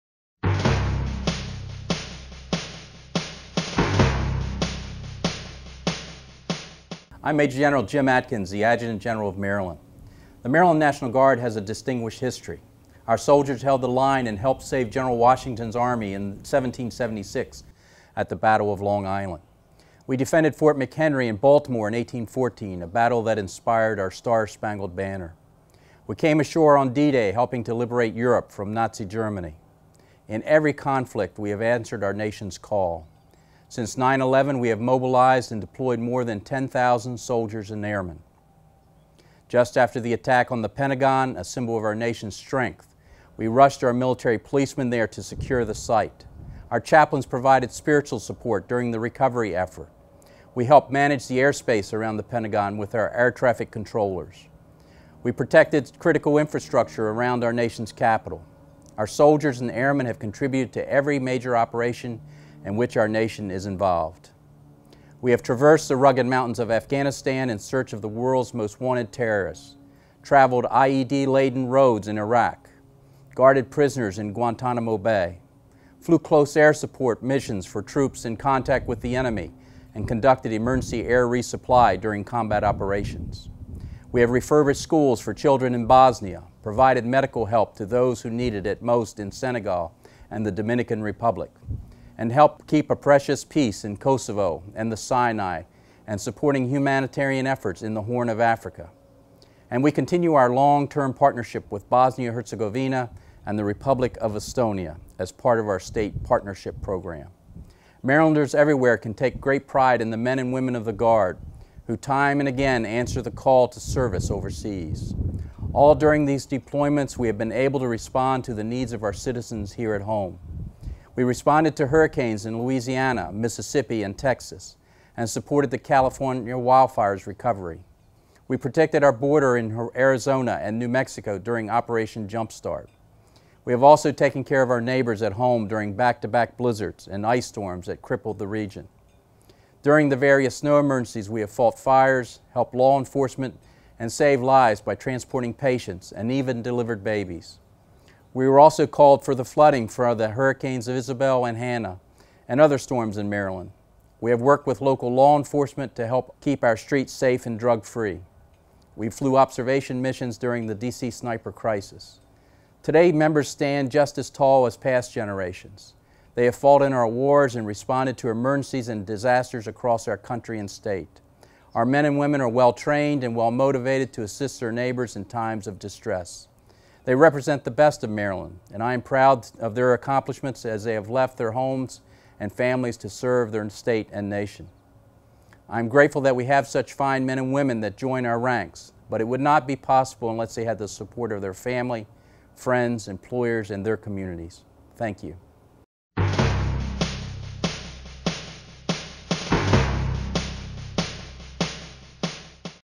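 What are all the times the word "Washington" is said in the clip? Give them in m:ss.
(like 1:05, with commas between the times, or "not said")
0:15.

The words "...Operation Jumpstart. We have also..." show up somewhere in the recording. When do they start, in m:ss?
2:11.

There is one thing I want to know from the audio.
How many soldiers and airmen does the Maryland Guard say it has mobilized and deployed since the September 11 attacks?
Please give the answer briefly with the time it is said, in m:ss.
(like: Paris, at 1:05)
More than 10,000, at 0:35.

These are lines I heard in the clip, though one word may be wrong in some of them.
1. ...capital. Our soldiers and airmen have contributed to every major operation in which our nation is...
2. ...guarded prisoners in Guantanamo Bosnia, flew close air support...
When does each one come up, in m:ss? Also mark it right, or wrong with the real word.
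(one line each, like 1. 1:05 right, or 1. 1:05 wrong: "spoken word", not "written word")
1. 0:57 right
2. 1:13 wrong: "Bay", not "Bosnia".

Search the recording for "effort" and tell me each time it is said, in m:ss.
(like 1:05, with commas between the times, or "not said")
0:49, 1:37.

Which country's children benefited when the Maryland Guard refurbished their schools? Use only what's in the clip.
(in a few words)
Bosnia.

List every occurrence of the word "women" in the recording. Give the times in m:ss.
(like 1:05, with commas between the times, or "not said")
1:50, 2:52, 3:07.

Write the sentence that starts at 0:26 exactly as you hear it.
We came ashore on D-Day helping to liberate Europe from Nazi Germany.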